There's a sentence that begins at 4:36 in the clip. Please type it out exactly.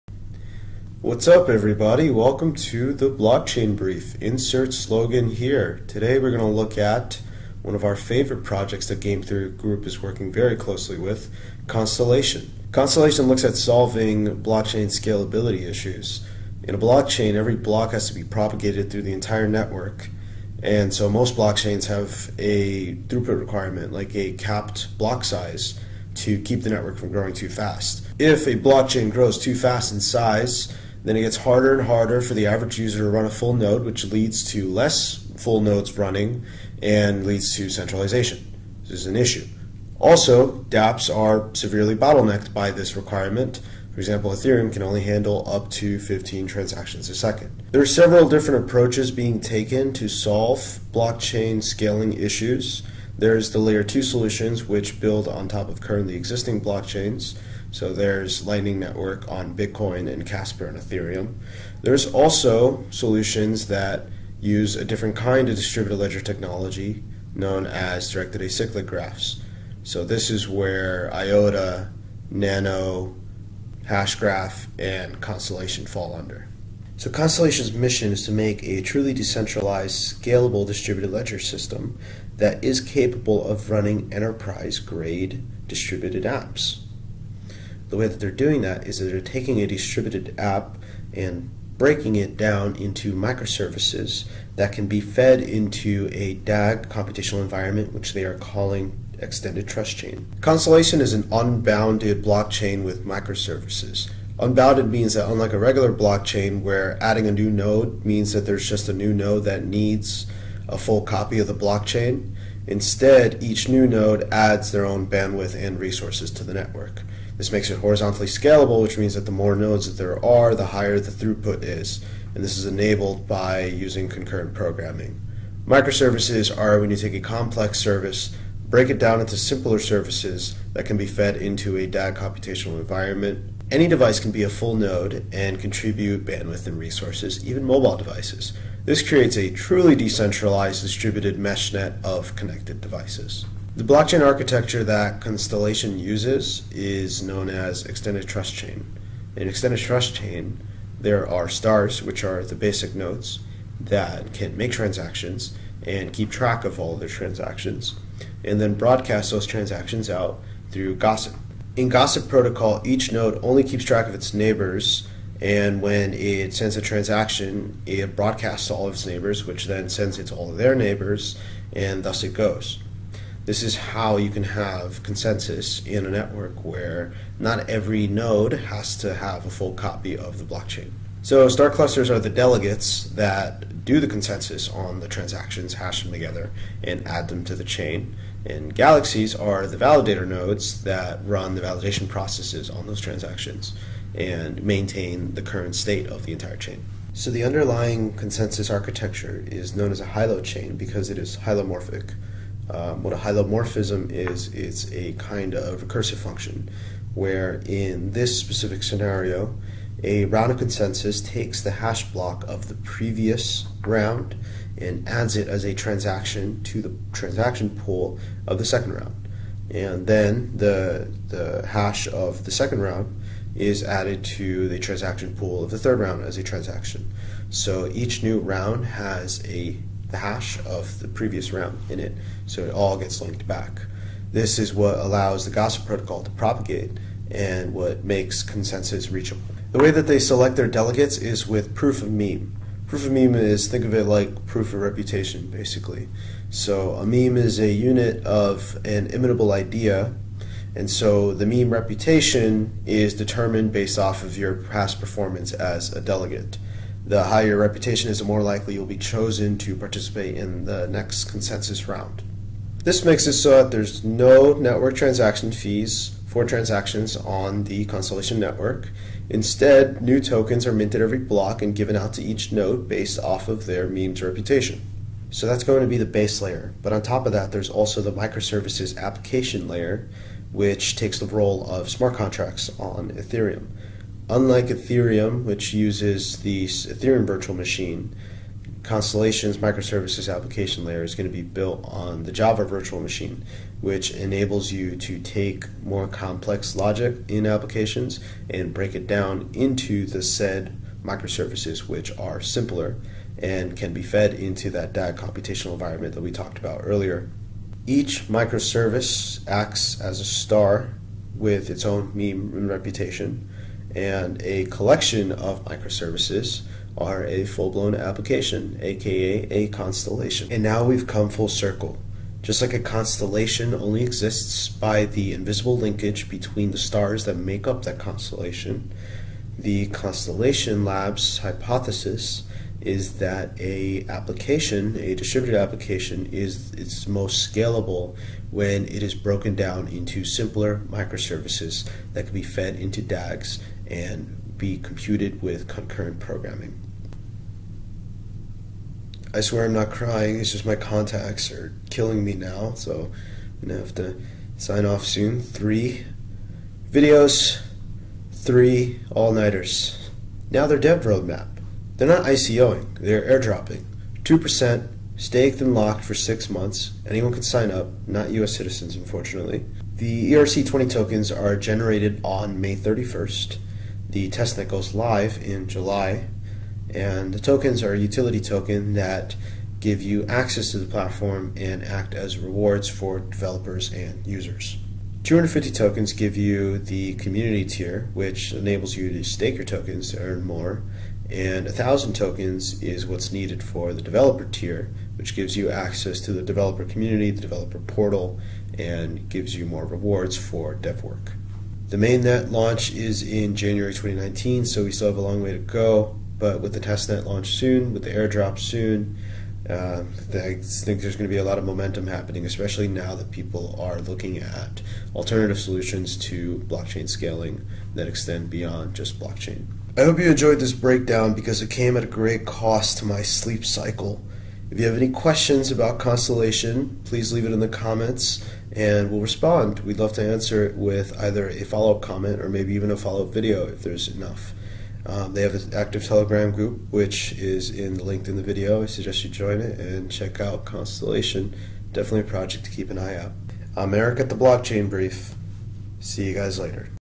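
But on top of that, there's also the microservices application layer, which takes the role of smart contracts on Ethereum.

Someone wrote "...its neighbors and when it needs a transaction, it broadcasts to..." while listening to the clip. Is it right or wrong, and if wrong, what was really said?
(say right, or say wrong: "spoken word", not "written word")
wrong: "sends", not "needs".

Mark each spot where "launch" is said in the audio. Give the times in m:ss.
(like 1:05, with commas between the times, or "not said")
6:42, 6:47.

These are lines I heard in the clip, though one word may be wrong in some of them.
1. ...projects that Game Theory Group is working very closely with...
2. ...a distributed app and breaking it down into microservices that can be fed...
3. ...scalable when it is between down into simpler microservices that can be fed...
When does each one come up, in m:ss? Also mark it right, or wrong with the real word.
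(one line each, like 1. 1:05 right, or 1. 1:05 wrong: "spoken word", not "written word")
1. 0:08 right
2. 1:29 right
3. 5:37 wrong: "broken", not "between".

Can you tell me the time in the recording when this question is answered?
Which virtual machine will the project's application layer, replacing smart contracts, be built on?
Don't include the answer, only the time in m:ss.
4:52.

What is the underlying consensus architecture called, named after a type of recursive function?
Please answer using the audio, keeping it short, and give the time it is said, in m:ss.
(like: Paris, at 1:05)
Hylochain, at 3:20.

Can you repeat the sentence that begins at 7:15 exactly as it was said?
Um, they have an active Telegram group, which is in the linked in the video.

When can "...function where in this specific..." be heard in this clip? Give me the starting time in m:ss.
3:26.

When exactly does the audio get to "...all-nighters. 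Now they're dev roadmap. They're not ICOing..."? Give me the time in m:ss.
5:59.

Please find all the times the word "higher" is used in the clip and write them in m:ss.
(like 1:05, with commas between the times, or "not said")
2:00, 4:17.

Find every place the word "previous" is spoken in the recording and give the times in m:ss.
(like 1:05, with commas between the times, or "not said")
3:32, 3:51.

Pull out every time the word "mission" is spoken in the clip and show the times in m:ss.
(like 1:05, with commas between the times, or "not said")
1:17.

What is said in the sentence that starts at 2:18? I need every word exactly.
This creates a truly decentralized distributed mesh net of connected devices.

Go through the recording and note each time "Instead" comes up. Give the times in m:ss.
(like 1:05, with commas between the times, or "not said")
1:52, 4:29.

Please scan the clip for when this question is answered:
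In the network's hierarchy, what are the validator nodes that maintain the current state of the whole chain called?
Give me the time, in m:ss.
3:08.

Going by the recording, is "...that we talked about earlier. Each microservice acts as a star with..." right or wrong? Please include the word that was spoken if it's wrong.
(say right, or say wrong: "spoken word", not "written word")
right.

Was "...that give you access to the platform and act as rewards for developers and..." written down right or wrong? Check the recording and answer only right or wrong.
right.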